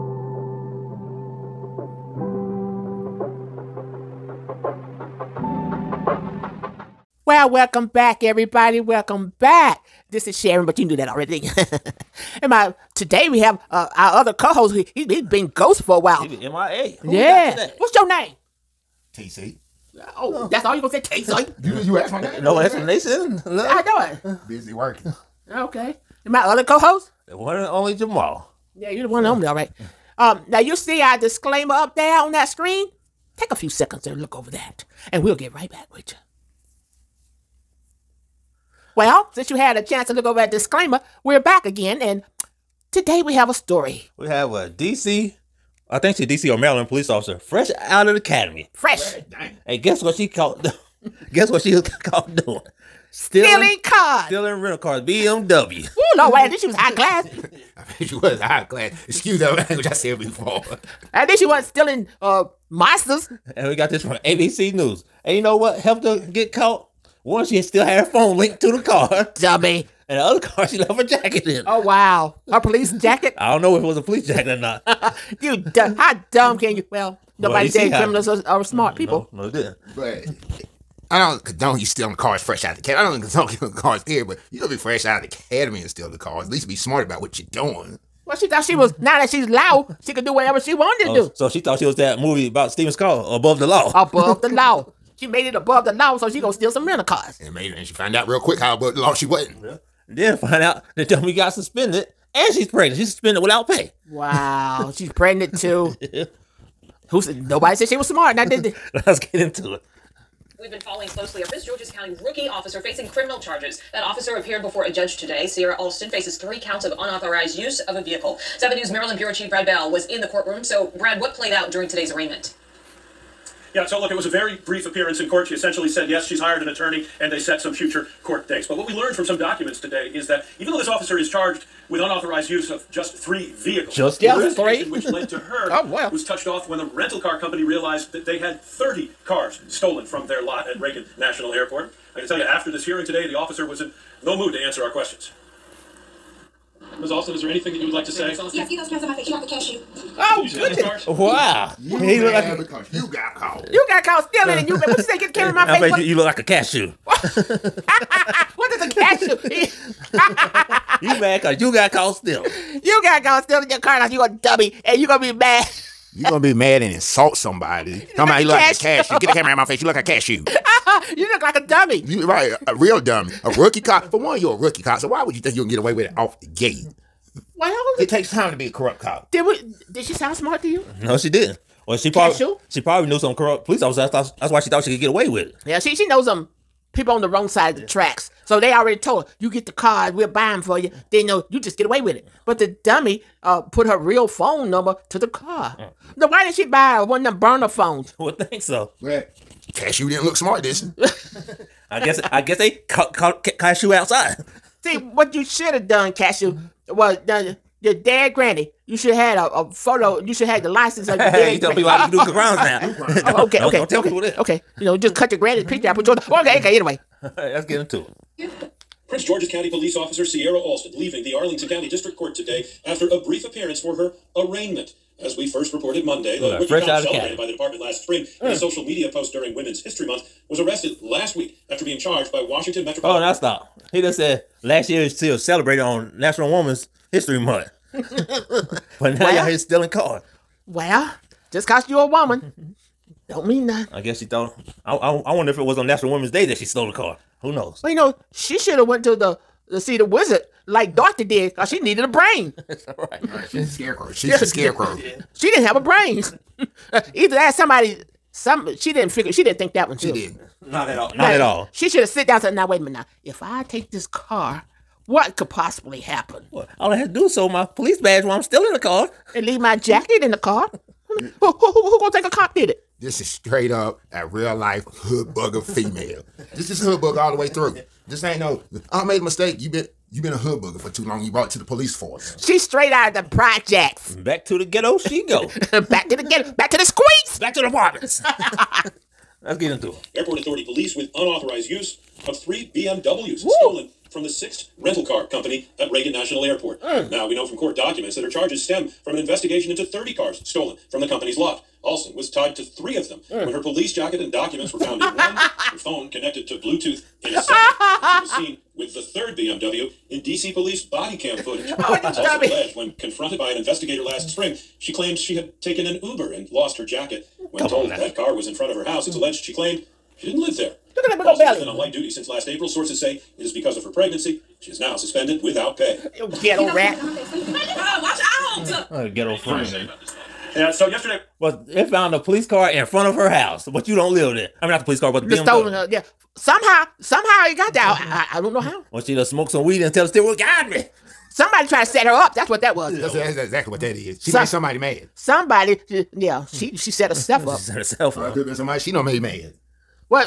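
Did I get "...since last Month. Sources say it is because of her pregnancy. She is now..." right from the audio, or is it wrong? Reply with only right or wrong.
wrong.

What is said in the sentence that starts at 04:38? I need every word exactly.
This ain't no, I made a mistake.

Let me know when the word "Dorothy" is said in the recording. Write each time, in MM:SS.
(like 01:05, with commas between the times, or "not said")
04:10.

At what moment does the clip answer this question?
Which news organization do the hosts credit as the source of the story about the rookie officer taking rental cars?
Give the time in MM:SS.
01:04.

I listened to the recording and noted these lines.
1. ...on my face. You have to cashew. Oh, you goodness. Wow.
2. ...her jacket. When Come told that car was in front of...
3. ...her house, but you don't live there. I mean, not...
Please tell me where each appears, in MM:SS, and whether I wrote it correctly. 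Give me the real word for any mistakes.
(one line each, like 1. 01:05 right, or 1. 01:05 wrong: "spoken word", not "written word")
1. 02:29 right
2. 05:16 right
3. 05:33 right.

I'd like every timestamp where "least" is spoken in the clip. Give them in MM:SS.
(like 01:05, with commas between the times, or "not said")
01:26.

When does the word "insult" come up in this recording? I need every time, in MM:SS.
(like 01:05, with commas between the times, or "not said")
02:46.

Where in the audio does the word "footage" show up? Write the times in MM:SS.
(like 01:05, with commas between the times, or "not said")
05:11.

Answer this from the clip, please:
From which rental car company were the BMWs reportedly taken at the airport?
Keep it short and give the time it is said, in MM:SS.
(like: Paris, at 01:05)
Sixt, at 04:54.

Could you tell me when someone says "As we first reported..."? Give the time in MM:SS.
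03:45.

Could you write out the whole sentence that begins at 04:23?
If I take this car what could possibly happen?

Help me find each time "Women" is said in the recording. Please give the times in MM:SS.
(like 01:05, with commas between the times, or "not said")
03:49, 03:56, 04:06.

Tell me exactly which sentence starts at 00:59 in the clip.
Excuse that language I said before.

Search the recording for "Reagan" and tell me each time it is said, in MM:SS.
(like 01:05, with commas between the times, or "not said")
02:20, 04:55.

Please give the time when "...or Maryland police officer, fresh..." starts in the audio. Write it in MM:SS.
00:46.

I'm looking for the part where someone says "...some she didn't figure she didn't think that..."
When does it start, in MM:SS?
04:18.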